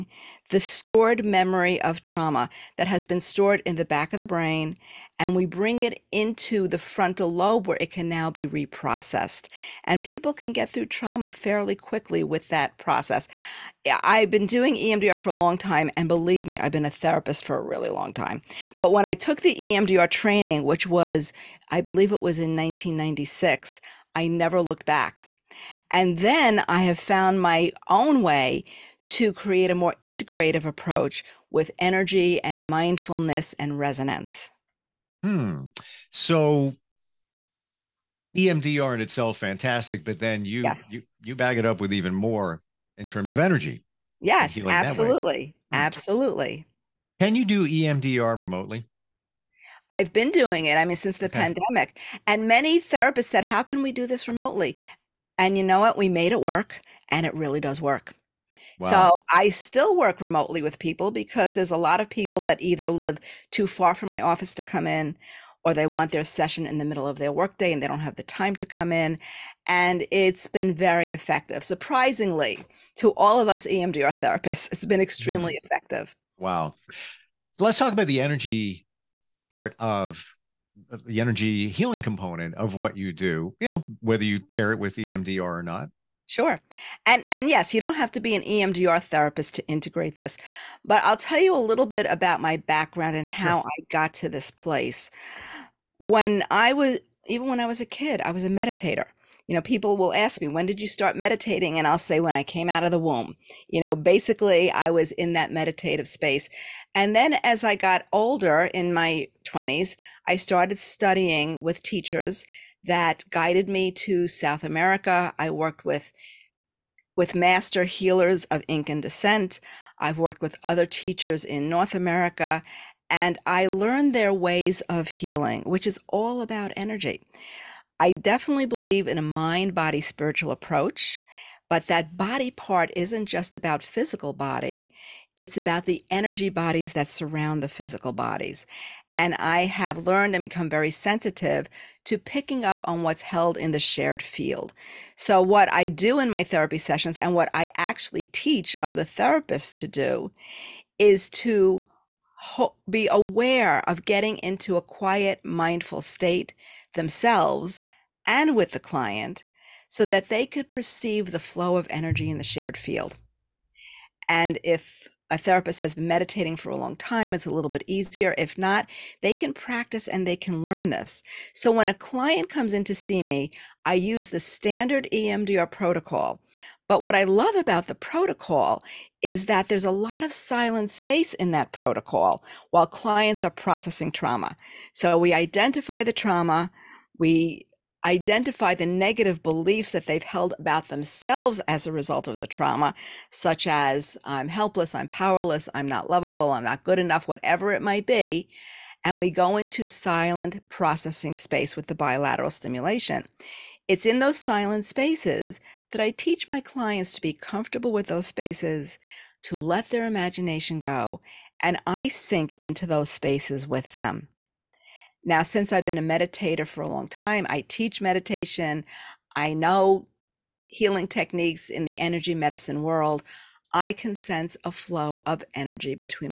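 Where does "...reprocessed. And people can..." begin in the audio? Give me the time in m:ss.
0:08.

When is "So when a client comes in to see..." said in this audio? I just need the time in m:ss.
2:51.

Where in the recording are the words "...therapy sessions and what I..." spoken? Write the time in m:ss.
2:26.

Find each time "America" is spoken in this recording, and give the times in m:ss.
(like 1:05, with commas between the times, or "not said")
1:54, 2:01.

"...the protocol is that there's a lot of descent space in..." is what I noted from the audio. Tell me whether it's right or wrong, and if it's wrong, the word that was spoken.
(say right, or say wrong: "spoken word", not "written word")
wrong: "silent", not "descent".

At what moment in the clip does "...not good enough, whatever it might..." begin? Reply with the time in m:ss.
3:16.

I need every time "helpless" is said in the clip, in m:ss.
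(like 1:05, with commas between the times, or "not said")
3:14.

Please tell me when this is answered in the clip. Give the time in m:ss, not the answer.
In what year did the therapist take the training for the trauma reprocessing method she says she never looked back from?
0:22.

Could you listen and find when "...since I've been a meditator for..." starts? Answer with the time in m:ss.
3:35.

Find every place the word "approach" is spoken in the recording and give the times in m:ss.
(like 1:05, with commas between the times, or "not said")
0:30, 2:10.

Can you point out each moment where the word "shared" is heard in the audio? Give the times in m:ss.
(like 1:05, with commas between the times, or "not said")
2:23, 2:42.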